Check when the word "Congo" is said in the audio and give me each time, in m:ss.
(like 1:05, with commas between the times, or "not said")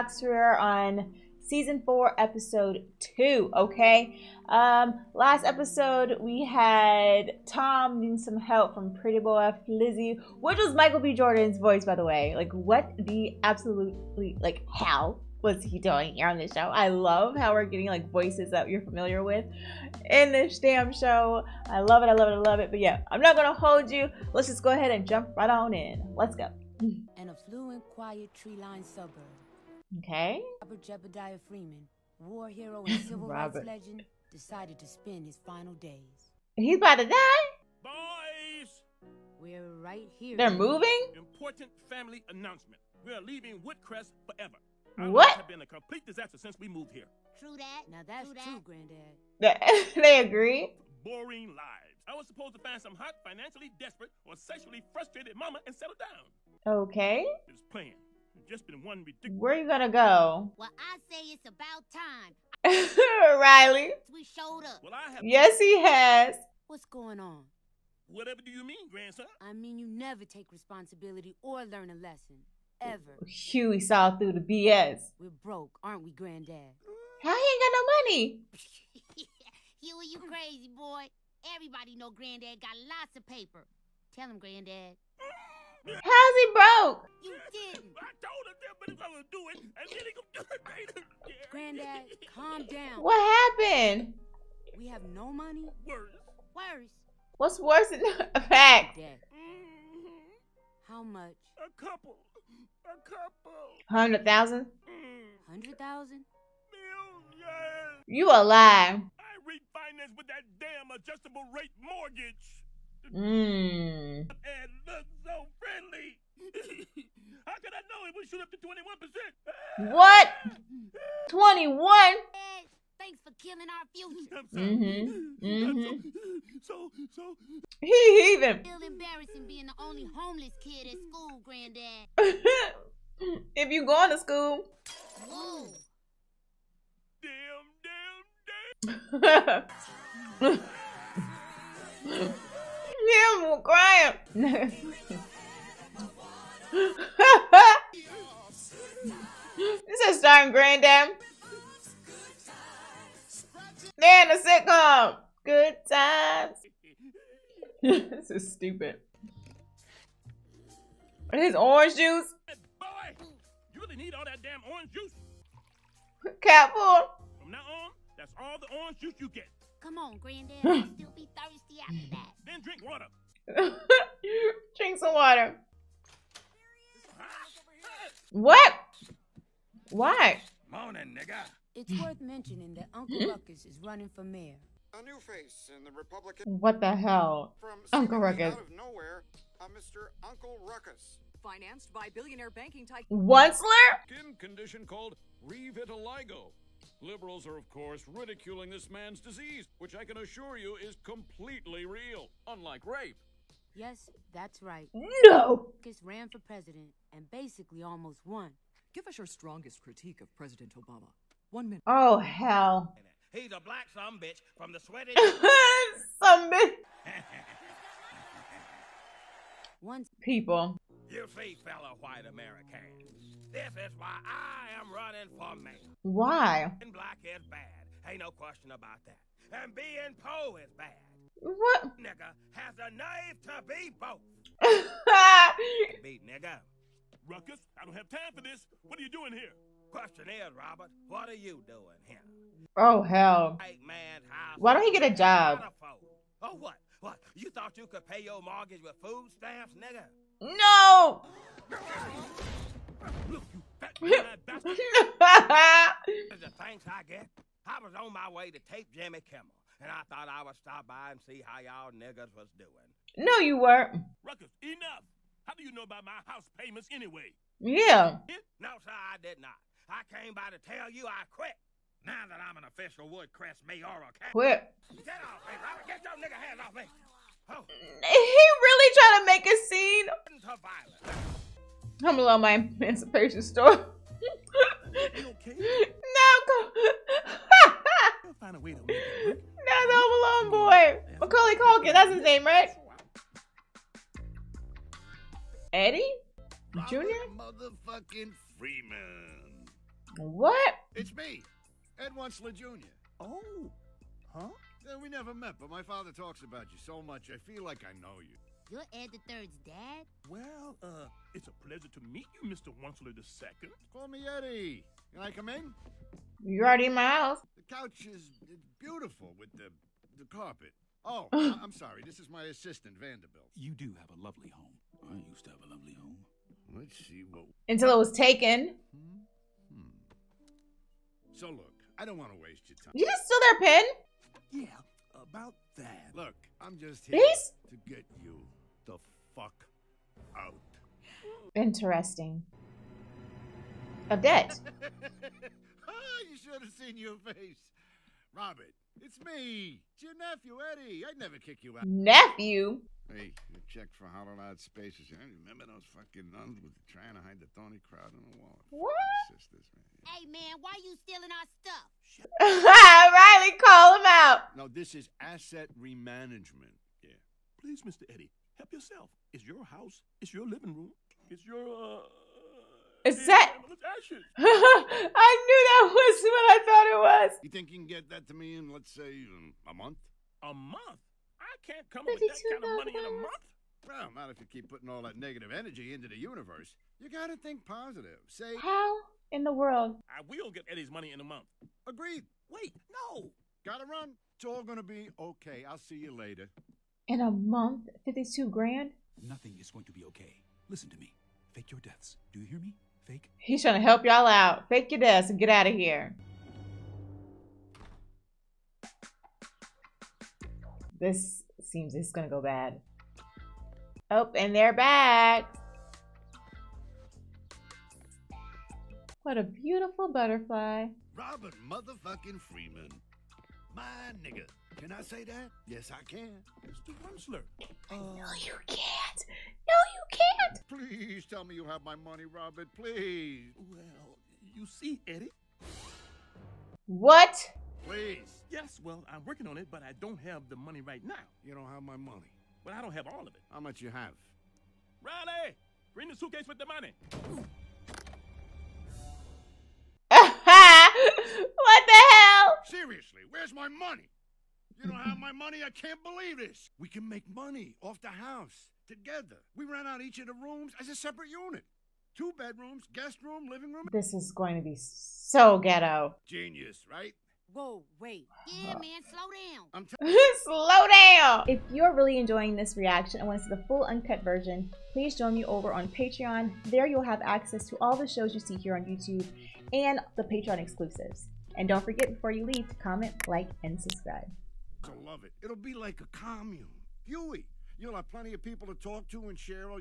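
not said.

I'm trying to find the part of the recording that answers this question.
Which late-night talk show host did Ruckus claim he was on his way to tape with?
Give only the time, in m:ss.
4:18.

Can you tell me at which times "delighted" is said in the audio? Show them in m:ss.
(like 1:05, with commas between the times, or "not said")
not said.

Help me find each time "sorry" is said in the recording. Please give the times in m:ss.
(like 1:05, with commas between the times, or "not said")
5:21.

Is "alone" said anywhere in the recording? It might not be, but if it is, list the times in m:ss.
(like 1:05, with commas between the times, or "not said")
4:42, 4:50.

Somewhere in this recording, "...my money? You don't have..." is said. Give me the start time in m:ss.
7:33.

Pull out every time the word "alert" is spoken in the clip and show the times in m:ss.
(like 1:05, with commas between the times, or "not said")
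not said.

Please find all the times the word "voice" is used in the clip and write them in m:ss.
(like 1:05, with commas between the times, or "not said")
0:11, 0:18.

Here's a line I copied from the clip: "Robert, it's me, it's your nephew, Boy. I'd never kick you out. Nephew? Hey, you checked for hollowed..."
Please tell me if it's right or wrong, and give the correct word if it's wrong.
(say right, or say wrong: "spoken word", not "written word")
wrong: "Eddie", not "Boy".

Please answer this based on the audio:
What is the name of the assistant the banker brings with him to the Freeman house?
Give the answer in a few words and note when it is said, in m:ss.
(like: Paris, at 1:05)
Vanderbilt, at 5:22.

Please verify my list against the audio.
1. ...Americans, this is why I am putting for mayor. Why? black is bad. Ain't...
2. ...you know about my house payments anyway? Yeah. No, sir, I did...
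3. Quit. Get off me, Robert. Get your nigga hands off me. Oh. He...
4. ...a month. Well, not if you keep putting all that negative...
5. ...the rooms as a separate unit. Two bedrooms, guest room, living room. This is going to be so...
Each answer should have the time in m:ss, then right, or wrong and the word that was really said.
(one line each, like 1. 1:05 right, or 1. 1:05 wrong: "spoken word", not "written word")
1. 3:42 wrong: "running", not "putting"
2. 4:25 right
3. 4:34 right
4. 6:23 right
5. 7:40 right.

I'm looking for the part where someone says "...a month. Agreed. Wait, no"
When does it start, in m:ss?
6:31.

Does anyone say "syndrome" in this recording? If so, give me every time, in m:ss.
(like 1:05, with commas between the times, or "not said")
not said.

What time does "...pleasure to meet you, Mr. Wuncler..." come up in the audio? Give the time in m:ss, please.
5:11.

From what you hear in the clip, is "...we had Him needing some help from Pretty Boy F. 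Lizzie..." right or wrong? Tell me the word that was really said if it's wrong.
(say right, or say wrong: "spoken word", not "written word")
wrong: "Tom", not "Him".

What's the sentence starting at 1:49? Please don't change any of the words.
I refinance with that damn adjustable rate mortgage.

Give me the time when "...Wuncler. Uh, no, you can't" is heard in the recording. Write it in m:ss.
7:07.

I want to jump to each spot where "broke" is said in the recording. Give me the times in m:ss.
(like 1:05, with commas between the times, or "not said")
1:15, 1:26.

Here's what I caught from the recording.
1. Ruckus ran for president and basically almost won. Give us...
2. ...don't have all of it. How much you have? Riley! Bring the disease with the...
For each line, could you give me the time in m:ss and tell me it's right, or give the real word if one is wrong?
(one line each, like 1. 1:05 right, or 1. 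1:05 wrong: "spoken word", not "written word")
1. 3:25 right
2. 7:22 wrong: "suitcase", not "disease".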